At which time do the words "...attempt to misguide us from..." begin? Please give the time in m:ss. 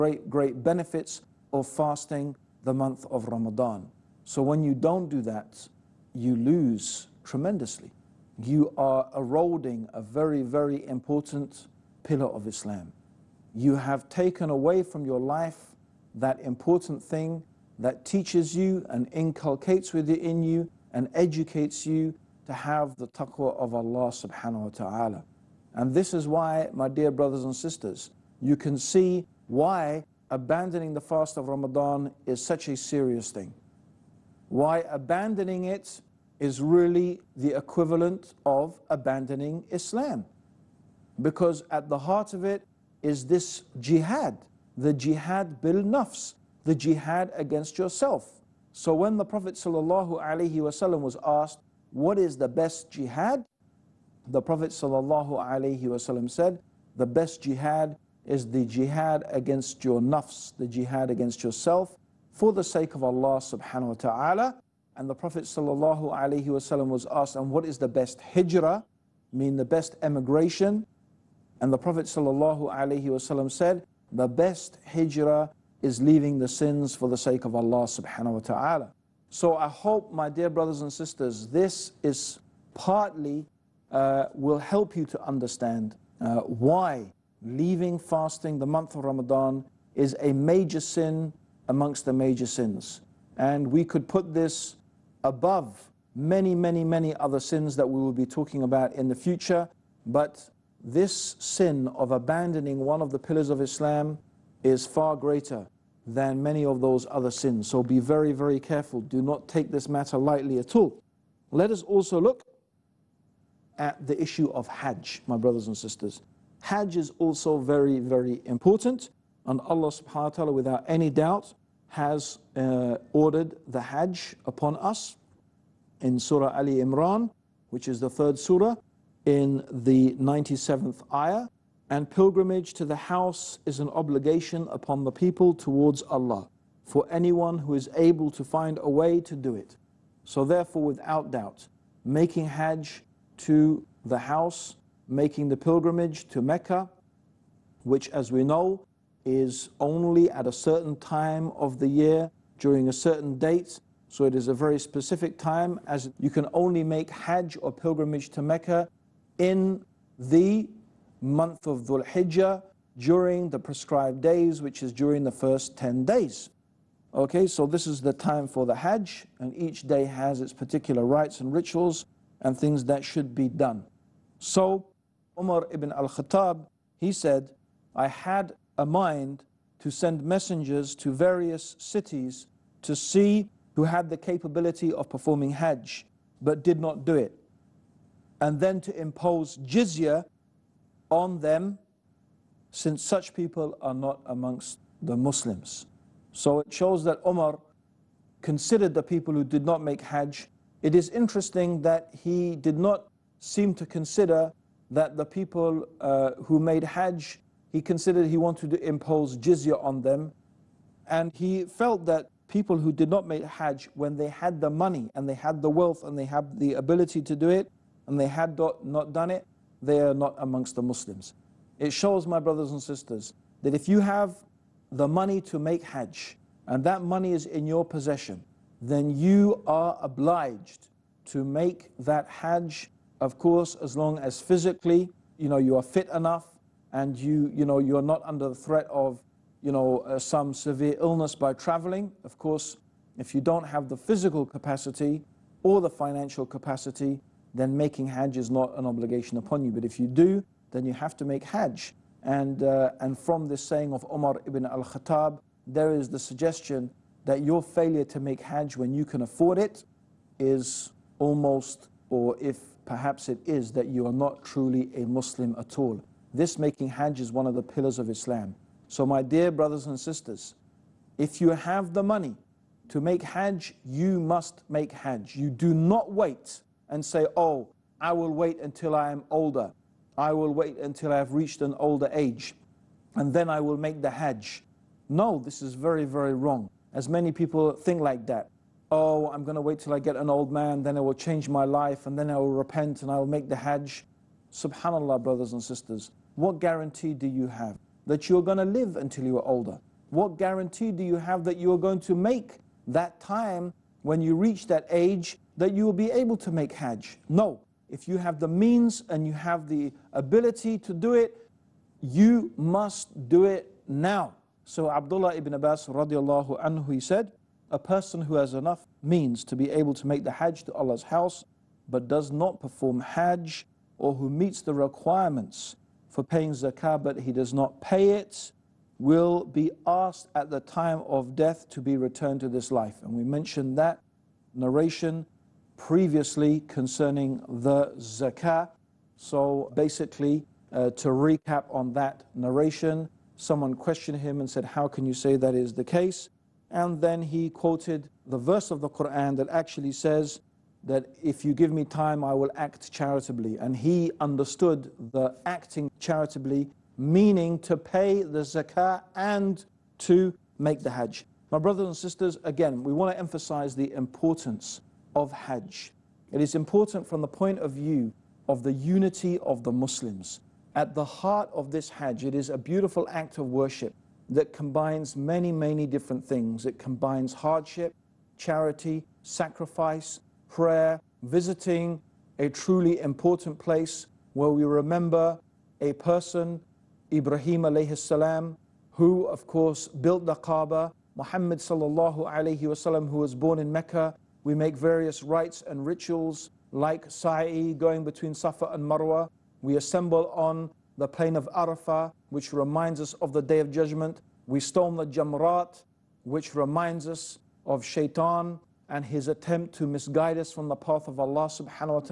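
6:49.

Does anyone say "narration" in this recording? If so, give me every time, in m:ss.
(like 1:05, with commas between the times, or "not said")
5:34, 5:42.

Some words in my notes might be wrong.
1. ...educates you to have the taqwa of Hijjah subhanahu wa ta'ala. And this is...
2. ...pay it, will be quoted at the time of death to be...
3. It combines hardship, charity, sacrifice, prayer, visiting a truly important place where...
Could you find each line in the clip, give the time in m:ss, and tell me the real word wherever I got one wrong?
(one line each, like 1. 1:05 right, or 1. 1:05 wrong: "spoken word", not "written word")
1. 0:21 wrong: "Allah", not "Hijjah"
2. 5:27 wrong: "asked", not "quoted"
3. 6:16 right.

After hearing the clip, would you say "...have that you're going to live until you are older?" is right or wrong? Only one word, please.
right.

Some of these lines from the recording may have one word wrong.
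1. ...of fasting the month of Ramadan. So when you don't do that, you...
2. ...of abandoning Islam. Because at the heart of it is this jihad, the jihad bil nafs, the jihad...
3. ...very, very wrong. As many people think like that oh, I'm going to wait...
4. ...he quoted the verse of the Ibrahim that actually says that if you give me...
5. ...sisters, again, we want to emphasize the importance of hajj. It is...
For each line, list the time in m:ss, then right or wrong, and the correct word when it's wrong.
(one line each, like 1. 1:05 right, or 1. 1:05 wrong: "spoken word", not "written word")
1. 0:01 right
2. 0:38 right
3. 4:45 right
4. 5:47 wrong: "Quran", not "Ibrahim"
5. 6:01 right.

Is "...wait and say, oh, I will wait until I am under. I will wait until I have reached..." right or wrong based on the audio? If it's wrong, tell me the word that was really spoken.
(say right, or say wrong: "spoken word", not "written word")
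wrong: "older", not "under".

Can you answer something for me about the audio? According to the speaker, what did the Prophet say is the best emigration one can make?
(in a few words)
Leaving the sins.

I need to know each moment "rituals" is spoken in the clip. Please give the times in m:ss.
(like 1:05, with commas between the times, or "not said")
2:51, 6:35.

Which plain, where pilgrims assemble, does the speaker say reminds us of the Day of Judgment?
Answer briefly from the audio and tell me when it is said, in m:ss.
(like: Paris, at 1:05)
Arafah, at 6:41.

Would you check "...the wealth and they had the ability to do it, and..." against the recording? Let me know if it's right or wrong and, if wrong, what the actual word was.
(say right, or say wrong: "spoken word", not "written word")
right.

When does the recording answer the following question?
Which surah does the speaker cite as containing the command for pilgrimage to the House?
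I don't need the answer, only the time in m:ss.
2:06.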